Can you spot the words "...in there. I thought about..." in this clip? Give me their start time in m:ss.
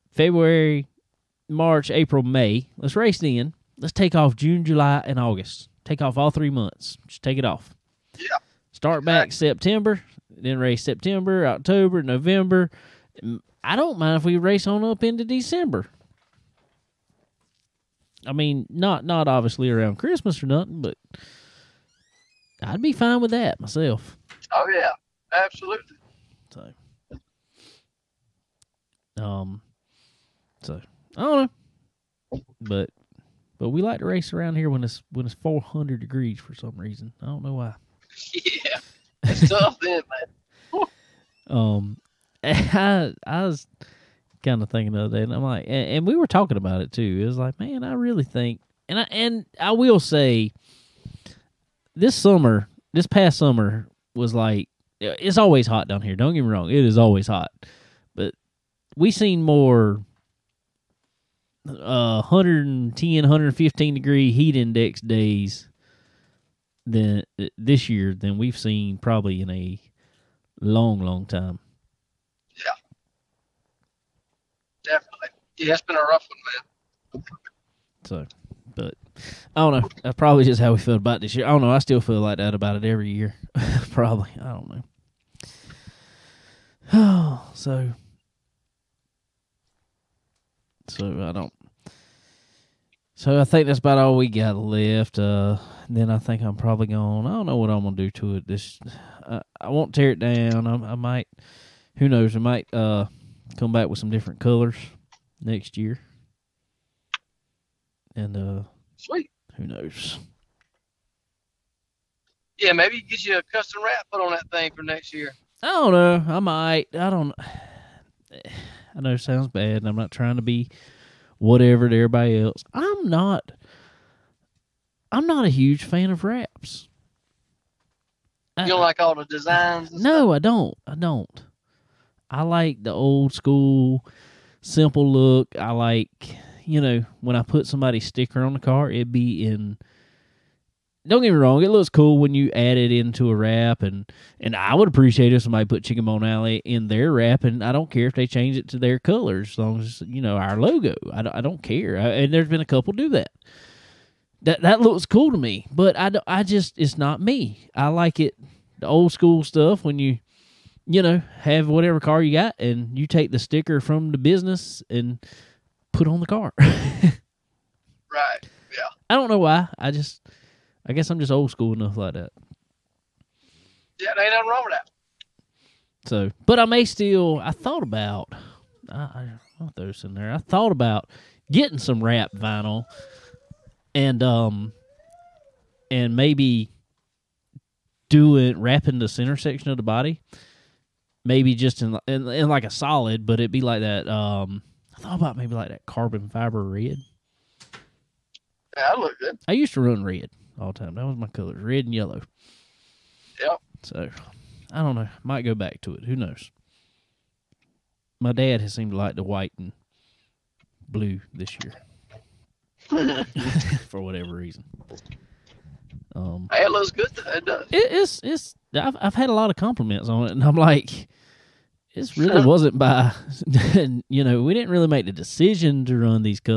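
3:00.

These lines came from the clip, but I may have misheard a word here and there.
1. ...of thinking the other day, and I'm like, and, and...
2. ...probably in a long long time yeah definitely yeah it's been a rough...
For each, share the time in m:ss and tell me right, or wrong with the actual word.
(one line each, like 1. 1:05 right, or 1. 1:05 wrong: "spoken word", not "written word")
1. 0:44 right
2. 1:08 right.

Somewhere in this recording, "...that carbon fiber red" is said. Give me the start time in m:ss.
3:15.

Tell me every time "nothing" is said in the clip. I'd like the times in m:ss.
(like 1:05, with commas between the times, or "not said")
0:20, 2:54.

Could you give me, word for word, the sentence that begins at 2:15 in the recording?
I like you know, when I put somebody's sticker on the car, it'd be in.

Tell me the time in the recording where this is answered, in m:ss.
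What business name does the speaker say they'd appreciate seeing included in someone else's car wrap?
2:25.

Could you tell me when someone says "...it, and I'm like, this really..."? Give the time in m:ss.
3:40.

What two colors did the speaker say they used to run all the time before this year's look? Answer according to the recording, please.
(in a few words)
Red and yellow.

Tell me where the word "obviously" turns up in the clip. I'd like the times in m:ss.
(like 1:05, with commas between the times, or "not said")
0:19.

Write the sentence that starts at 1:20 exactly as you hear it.
That's probably just how we feel about this year.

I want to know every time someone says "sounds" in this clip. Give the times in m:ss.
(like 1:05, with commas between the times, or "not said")
1:59.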